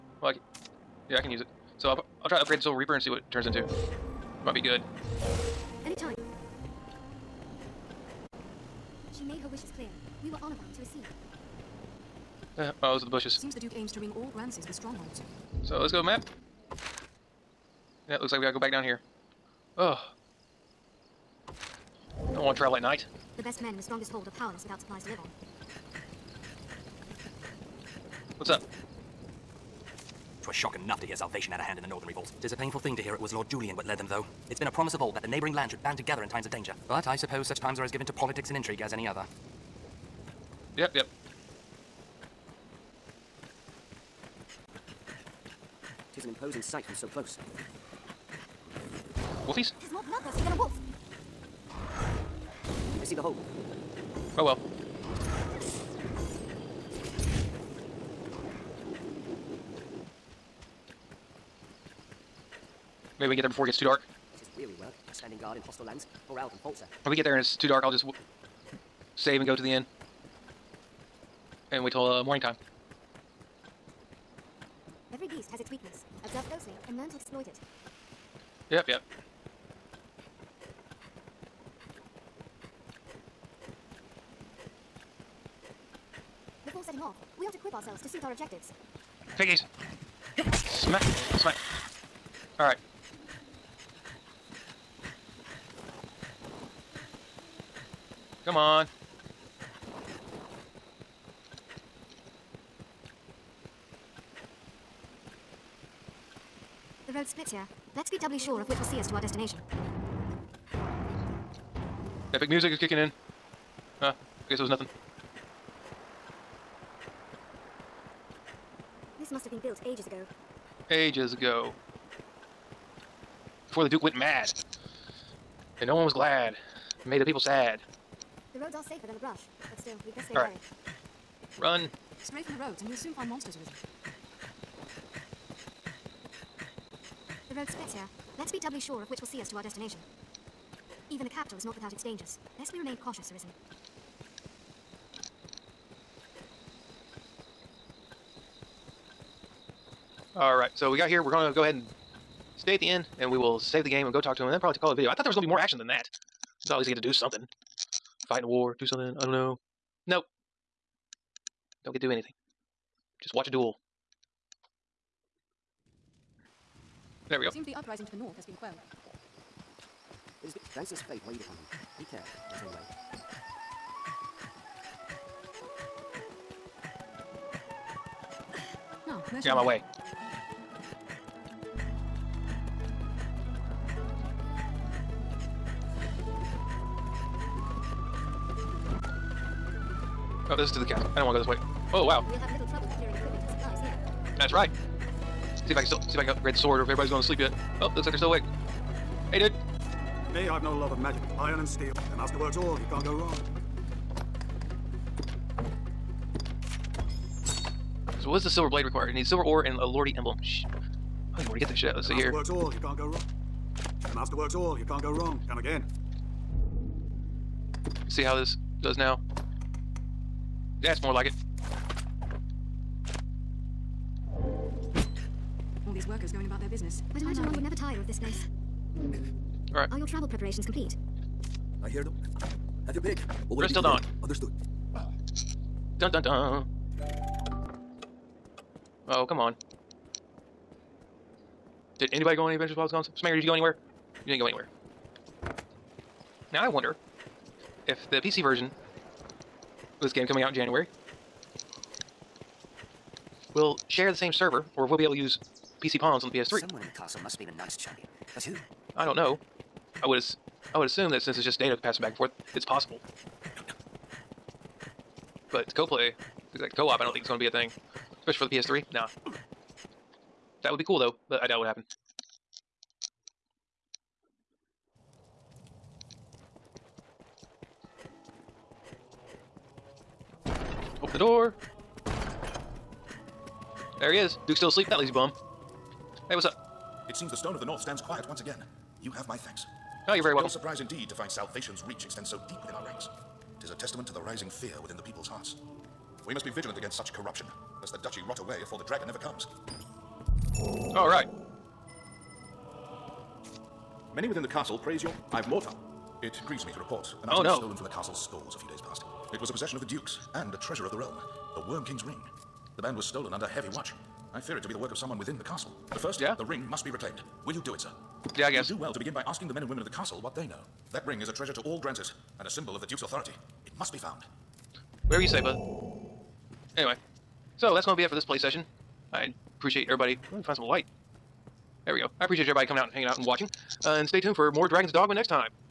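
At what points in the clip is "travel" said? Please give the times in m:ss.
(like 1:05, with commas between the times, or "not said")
0:22, 3:50.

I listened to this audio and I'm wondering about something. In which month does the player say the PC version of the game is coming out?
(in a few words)
January.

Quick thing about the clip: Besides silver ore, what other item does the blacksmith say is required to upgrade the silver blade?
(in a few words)
A lordy emblem.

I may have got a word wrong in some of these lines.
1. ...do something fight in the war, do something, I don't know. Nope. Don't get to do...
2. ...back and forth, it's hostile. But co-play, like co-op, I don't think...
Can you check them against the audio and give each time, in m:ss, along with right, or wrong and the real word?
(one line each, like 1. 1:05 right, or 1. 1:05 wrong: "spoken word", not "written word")
1. 2:36 right
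2. 4:22 wrong: "possible", not "hostile".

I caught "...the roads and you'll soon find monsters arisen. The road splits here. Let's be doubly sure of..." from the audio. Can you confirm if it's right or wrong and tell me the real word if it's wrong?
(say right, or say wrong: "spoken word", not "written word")
right.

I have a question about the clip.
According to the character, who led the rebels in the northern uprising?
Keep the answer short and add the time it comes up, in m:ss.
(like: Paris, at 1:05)
Lord Julian, at 0:33.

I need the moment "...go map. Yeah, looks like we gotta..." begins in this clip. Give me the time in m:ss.
0:15.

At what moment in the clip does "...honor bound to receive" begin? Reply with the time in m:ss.
0:10.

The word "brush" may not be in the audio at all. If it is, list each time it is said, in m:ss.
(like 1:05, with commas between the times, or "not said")
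2:09.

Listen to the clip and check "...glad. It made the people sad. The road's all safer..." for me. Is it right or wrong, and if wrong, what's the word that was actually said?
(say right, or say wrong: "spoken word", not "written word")
right.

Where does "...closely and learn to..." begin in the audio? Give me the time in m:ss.
1:16.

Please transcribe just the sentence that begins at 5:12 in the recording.
The band was stolen under heavy watch.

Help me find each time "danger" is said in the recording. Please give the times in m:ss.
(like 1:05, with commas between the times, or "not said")
0:36, 2:22.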